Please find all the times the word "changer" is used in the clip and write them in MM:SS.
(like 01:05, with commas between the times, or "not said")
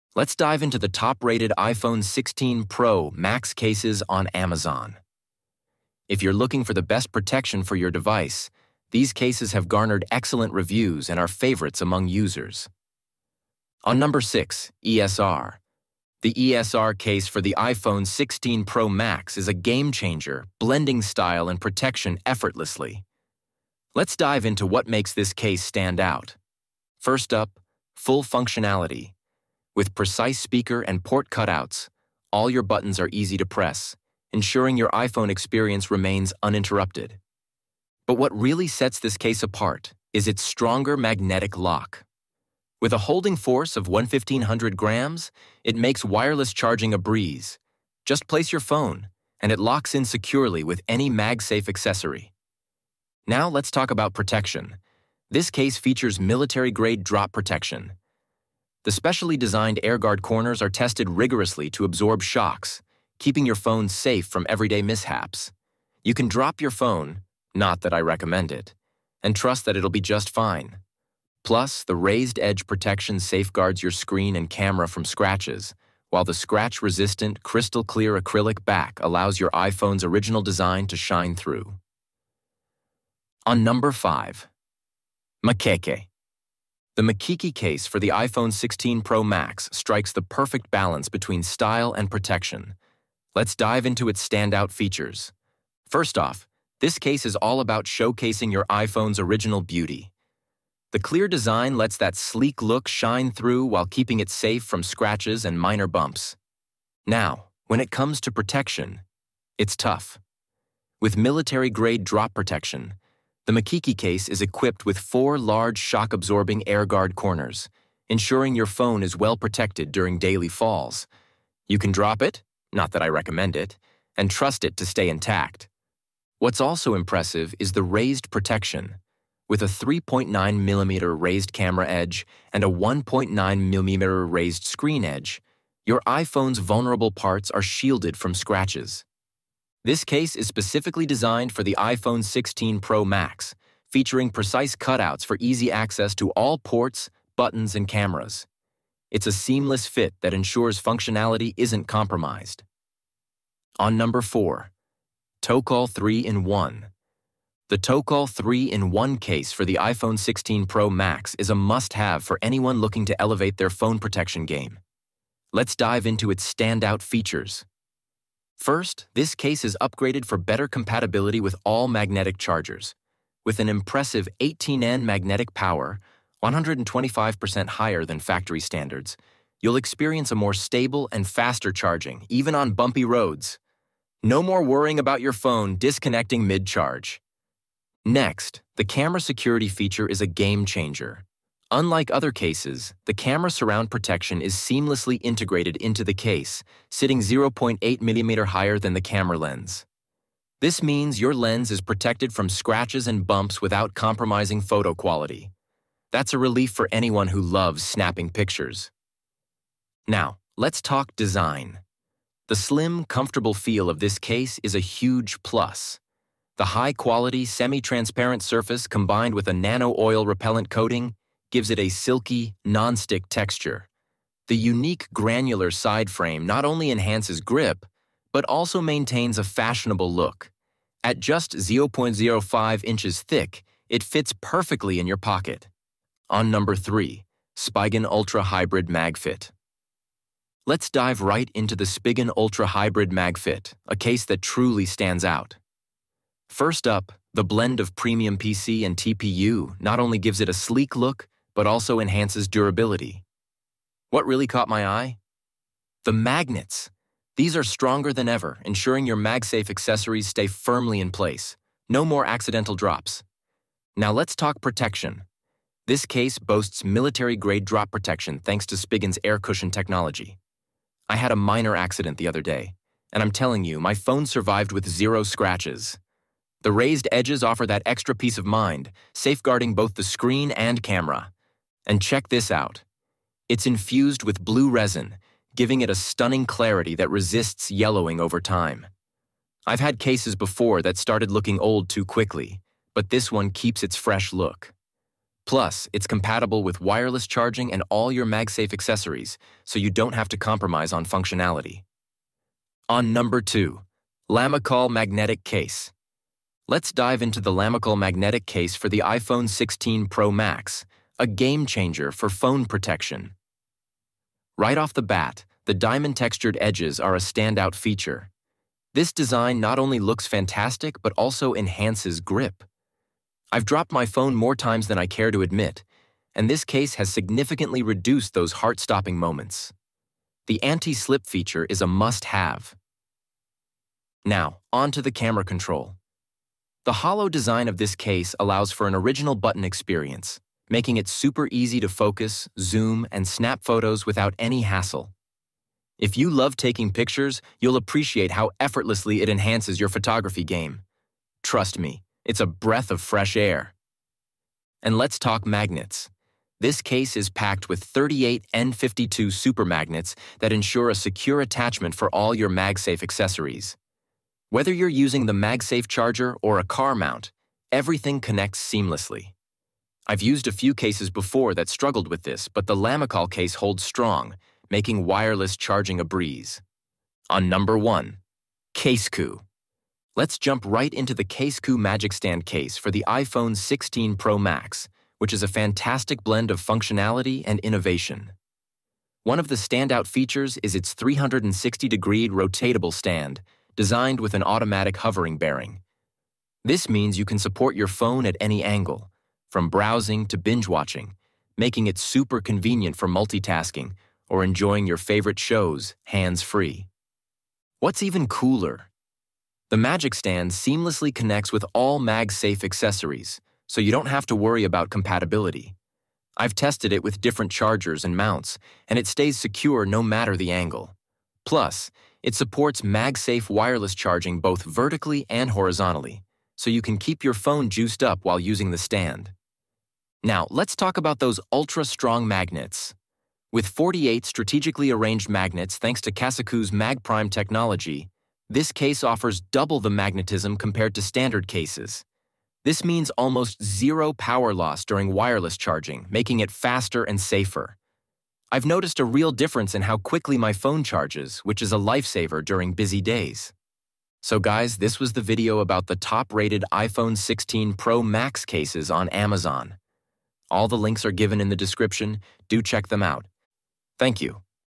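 00:19, 03:10, 05:11.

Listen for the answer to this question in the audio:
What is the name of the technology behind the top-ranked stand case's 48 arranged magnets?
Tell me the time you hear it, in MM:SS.
07:16.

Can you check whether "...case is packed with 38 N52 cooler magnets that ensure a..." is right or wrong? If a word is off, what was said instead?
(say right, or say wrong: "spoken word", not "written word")
wrong: "super", not "cooler".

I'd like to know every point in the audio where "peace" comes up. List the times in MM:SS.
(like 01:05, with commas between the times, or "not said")
04:38.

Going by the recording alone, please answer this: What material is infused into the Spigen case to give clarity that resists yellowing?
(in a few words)
blue resin.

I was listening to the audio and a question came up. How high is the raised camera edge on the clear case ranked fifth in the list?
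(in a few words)
3.9mm.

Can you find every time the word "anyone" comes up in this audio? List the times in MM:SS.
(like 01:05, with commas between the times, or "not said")
02:42, 03:26.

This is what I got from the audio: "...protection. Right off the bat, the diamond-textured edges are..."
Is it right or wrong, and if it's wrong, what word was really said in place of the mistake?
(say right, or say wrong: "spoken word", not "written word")
right.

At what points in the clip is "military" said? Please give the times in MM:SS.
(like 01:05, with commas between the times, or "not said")
00:56, 01:51, 04:26.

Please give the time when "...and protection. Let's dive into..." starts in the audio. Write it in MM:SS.
01:31.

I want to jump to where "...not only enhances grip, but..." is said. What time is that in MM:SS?
03:46.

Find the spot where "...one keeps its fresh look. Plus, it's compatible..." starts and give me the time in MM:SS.
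04:53.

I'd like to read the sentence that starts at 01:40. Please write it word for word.
The clear design lets that sleek look shine through while keeping it safe from scratches and minor bumps.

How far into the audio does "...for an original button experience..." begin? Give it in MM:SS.
05:38.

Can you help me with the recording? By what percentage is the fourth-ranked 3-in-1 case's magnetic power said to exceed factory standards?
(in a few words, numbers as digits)
125%.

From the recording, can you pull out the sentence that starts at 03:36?
The high-quality, semi-transparent surface combined with a nano-oil repellent coating gives it a silky, non-stick texture.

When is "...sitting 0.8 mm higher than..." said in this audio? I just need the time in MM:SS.
03:16.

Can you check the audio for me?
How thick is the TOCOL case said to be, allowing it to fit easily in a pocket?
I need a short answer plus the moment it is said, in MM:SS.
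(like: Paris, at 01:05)
0.05 inches, at 03:51.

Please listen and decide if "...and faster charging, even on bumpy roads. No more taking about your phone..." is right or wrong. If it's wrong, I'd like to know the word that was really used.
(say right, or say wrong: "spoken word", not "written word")
wrong: "worrying", not "taking".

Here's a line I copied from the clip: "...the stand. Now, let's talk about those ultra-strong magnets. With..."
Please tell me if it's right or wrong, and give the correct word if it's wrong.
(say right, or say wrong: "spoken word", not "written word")
right.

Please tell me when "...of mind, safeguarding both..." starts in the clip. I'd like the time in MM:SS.
04:38.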